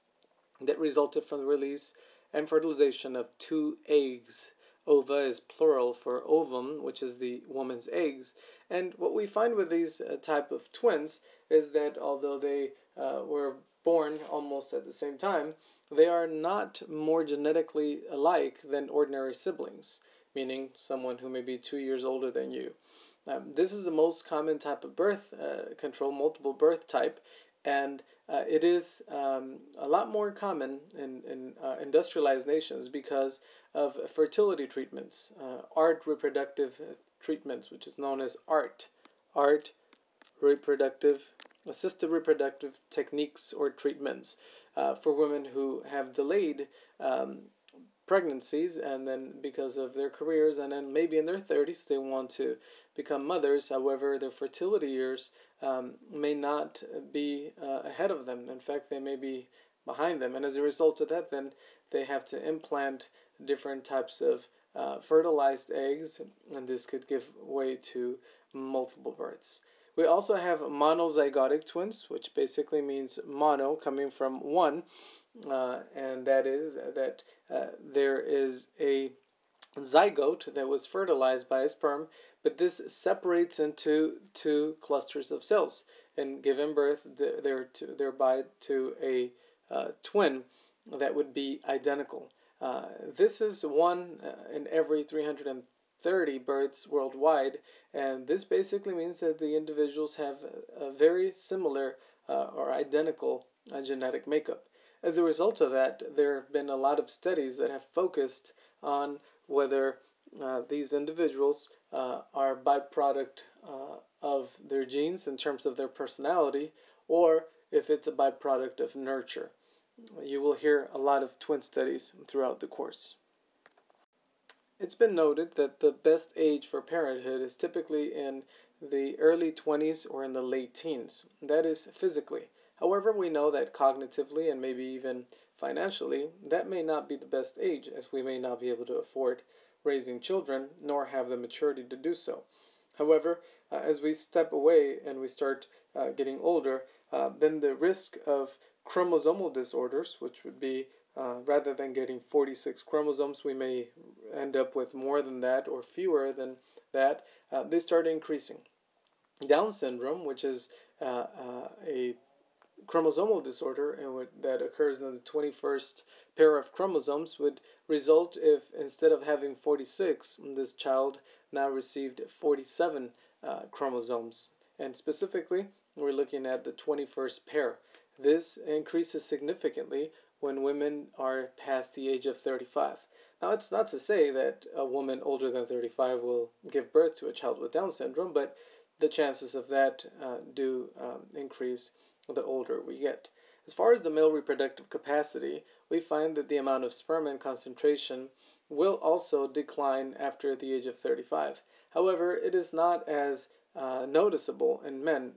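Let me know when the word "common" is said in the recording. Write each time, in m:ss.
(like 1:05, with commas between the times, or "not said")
0:24, 0:30.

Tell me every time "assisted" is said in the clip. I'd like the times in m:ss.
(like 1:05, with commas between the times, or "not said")
0:41.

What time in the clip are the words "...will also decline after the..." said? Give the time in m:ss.
3:18.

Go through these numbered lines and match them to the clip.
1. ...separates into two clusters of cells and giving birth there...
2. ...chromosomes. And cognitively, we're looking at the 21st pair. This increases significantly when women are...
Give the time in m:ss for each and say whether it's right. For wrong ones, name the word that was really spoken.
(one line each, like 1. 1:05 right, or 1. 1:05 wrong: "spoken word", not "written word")
1. 1:22 right
2. 2:53 wrong: "specifically", not "cognitively".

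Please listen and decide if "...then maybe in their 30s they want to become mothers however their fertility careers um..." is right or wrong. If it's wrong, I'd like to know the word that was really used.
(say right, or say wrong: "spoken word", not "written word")
wrong: "years", not "careers".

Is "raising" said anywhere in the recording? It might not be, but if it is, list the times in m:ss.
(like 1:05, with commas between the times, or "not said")
2:19.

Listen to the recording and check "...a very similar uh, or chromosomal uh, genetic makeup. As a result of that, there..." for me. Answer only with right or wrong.
wrong.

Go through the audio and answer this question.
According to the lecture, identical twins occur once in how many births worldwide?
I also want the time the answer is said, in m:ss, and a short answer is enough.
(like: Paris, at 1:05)
330, at 1:35.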